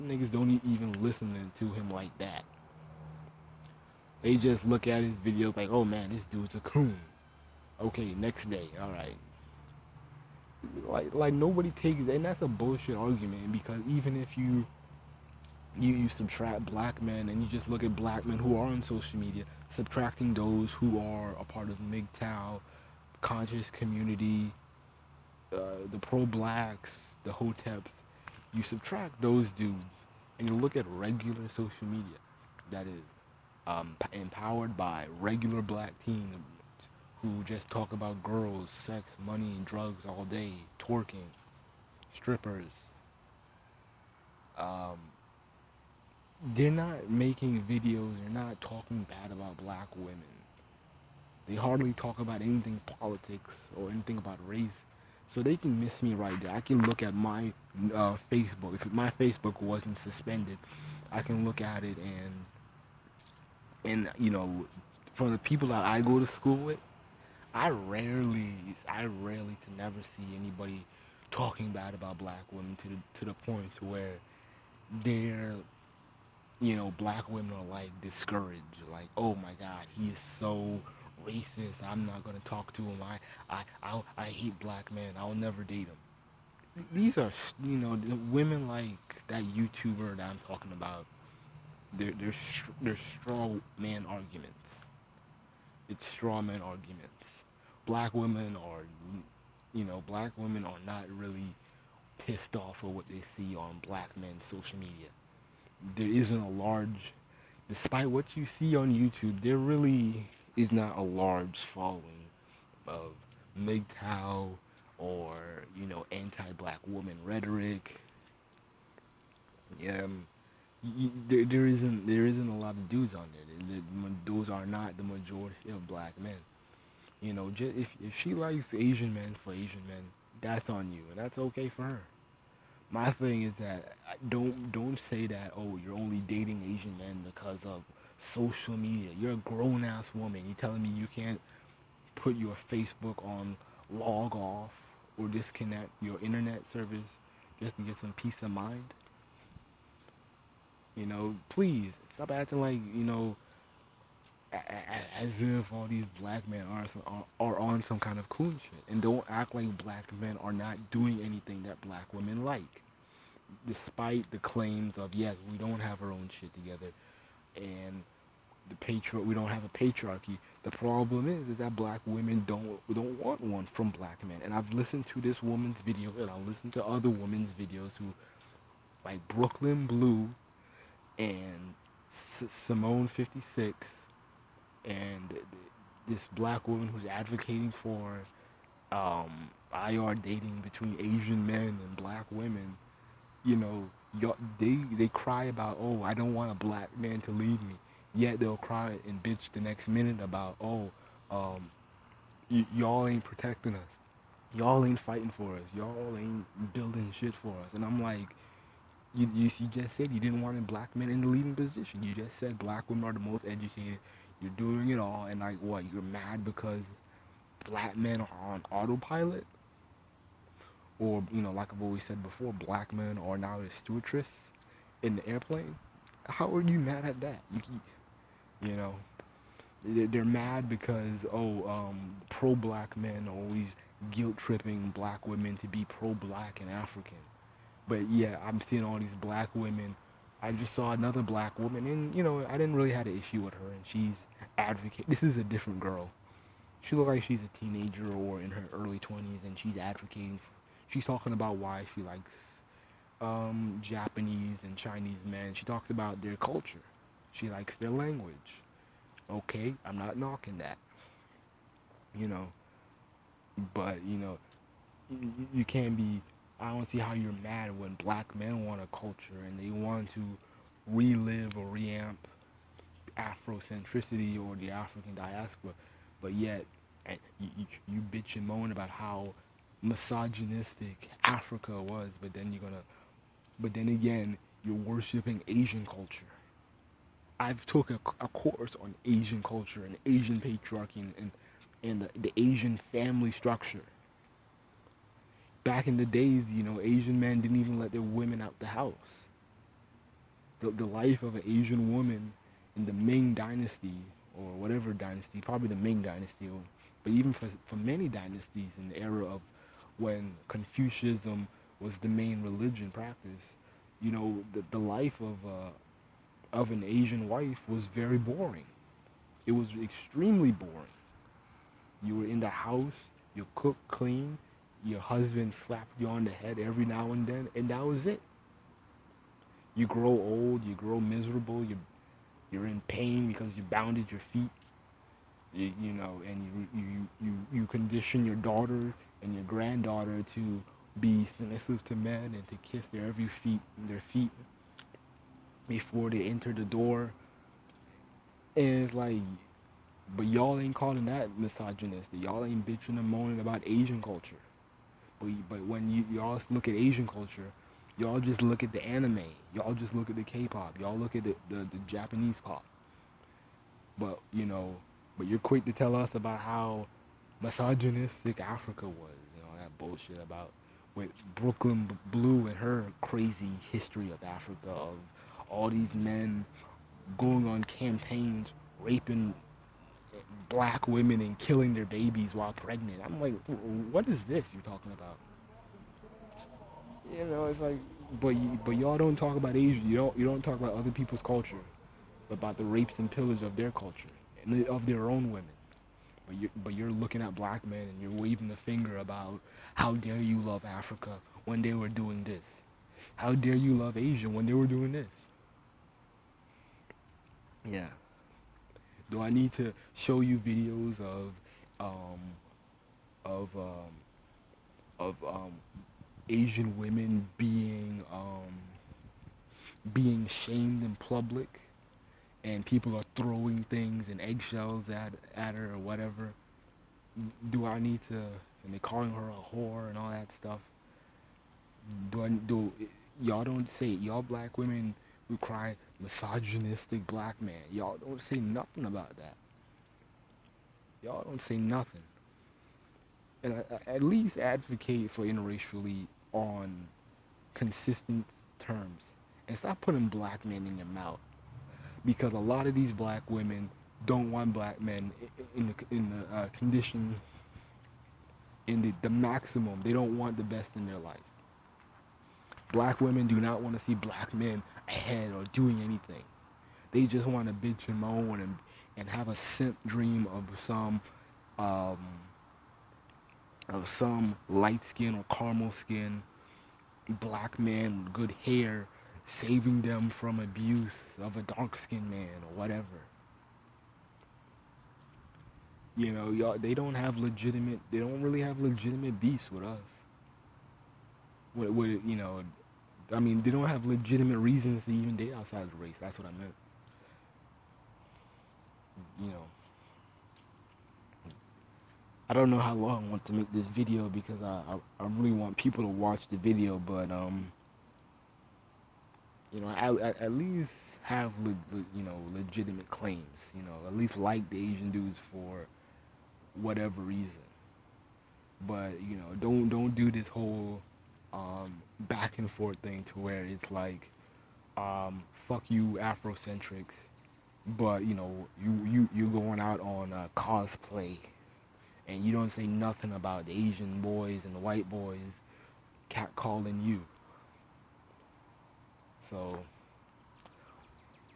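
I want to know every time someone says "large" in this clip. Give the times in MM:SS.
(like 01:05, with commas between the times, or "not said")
01:46, 01:51.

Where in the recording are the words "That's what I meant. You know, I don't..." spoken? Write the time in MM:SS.
08:16.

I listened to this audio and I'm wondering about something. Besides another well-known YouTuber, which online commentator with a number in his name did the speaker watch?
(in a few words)
Simone 56.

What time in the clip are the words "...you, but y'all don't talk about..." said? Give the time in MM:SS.
06:28.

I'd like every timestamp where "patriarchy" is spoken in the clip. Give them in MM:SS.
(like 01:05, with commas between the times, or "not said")
02:49, 04:50.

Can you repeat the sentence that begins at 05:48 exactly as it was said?
And it's like, but y'all ain't calling that misogynistic.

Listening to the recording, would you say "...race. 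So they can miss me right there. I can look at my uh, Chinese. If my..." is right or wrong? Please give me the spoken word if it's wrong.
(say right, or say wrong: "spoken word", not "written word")
wrong: "Facebook", not "Chinese".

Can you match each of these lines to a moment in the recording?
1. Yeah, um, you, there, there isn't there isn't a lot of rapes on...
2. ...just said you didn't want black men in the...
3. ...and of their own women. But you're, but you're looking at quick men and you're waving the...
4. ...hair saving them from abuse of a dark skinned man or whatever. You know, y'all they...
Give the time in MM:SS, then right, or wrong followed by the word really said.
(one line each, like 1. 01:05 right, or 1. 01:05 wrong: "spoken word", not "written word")
1. 01:59 wrong: "dudes", not "rapes"
2. 03:29 right
3. 06:34 wrong: "black", not "quick"
4. 07:58 right.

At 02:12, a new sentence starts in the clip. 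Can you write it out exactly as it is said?
My thing is that don't don't say that oh you're only dating Asian men because of social media.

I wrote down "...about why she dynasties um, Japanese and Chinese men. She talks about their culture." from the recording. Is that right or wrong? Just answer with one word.
wrong.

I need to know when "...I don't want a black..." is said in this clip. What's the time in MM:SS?
03:16.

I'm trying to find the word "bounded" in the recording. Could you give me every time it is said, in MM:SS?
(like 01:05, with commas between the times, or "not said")
05:33.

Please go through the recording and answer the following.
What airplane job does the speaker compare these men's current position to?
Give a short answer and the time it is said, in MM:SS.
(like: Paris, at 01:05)
stewardess, at 03:43.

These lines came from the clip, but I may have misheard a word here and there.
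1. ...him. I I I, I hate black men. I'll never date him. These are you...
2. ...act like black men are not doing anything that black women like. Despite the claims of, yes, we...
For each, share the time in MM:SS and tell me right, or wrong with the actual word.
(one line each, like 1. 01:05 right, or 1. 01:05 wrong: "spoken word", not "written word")
1. 01:22 right
2. 02:39 right.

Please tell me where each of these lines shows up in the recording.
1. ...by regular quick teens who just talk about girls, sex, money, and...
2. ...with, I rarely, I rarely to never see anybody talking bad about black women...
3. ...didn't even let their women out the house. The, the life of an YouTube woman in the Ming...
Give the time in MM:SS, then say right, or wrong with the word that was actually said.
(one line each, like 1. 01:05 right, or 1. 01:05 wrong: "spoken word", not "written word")
1. 00:34 wrong: "black", not "quick"
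2. 01:06 right
3. 04:57 wrong: "Asian", not "YouTube".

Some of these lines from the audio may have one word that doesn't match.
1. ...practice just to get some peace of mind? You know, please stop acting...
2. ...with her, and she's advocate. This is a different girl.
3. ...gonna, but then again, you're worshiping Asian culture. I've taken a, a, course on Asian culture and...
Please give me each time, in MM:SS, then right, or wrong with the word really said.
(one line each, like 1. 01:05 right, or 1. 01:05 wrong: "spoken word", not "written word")
1. 02:26 wrong: "service", not "practice"
2. 04:03 right
3. 04:42 right.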